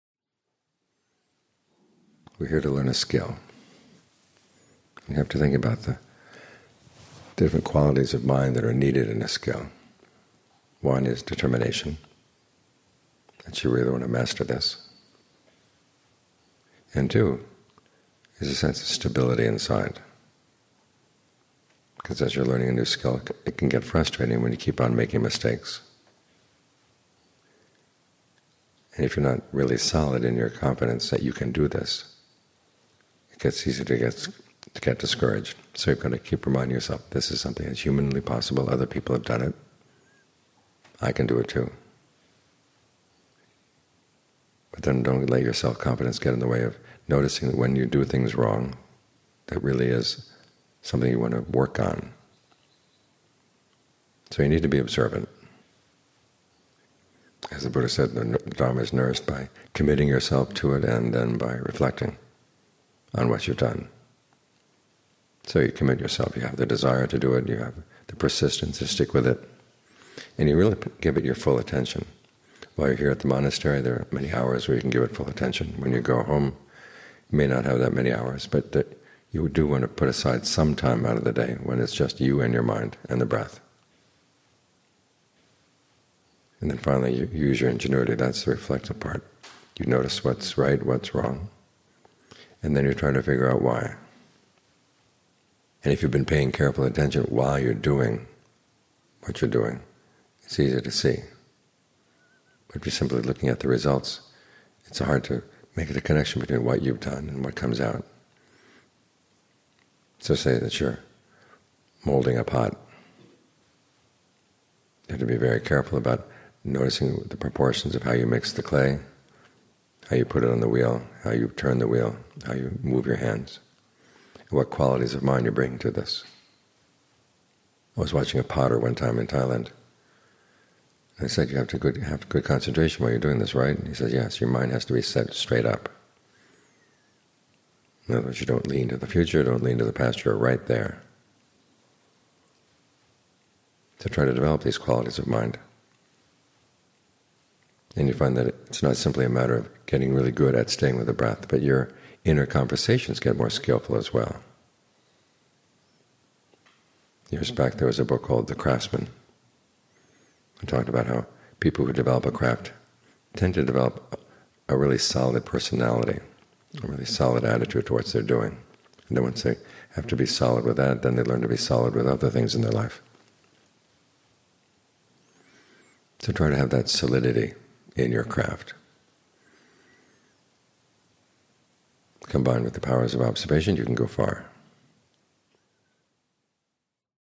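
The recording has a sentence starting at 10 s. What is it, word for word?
One is determination, that you really want to master this.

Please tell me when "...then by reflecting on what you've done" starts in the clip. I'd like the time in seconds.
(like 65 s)
61 s.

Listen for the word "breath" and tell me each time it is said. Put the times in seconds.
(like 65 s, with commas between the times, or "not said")
83 s, 151 s.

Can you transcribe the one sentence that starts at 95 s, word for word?
And if you've been paying careful attention while you're doing what you're doing, it's easy to see.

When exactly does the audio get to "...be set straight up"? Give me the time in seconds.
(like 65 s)
134 s.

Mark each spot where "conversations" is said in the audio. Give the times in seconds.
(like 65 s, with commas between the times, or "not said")
152 s.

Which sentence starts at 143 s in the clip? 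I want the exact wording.
To try to develop these qualities of mind.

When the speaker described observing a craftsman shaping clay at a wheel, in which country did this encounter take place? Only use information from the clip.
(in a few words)
Thailand.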